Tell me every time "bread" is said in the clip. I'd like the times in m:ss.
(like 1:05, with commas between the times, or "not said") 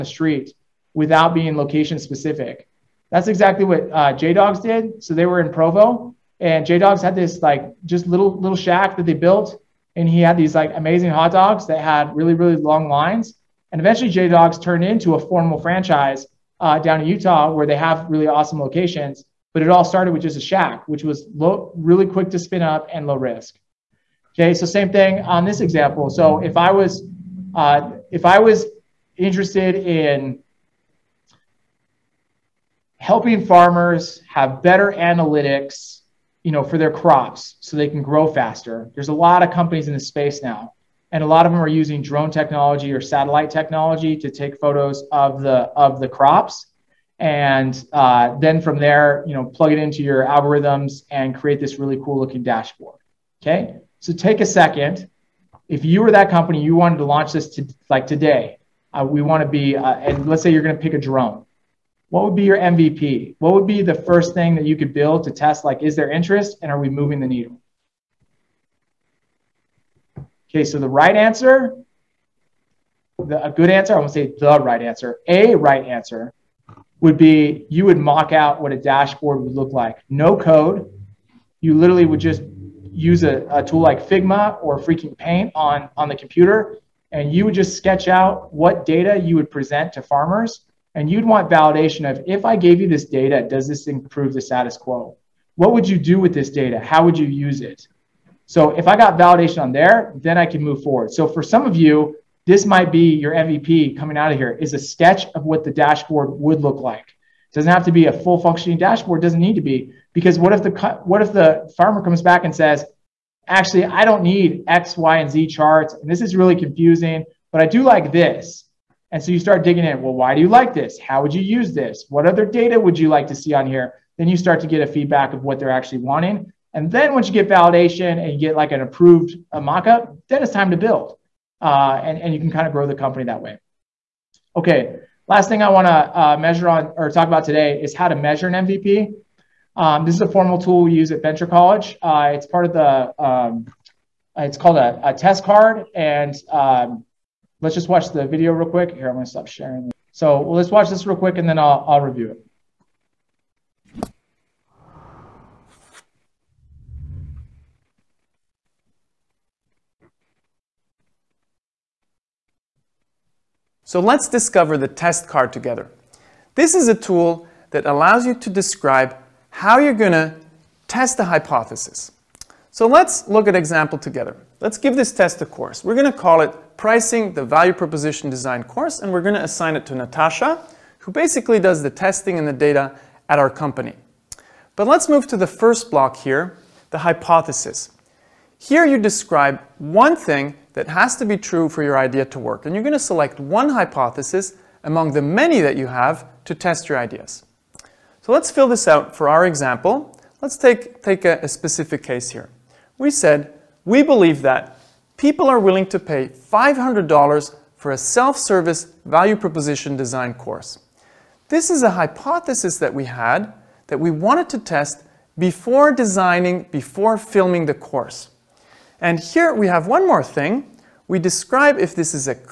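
not said.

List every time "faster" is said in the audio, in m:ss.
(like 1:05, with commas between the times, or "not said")
0:38.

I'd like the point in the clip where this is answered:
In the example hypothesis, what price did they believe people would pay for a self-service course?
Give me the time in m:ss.
3:26.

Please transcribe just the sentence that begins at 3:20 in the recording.
Let's take, take a, a specific case here.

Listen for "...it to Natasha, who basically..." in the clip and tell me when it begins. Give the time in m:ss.
2:59.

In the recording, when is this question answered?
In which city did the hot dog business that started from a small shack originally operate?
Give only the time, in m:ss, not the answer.
0:05.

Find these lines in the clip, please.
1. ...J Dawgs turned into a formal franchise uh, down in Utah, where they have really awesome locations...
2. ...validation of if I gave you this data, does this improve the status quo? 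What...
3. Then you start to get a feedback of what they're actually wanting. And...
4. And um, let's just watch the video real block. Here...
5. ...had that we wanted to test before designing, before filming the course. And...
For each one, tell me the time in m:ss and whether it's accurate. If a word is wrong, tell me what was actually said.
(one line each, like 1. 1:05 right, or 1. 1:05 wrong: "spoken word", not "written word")
1. 0:14 right
2. 1:31 right
3. 2:04 right
4. 2:25 wrong: "quick", not "block"
5. 3:33 right.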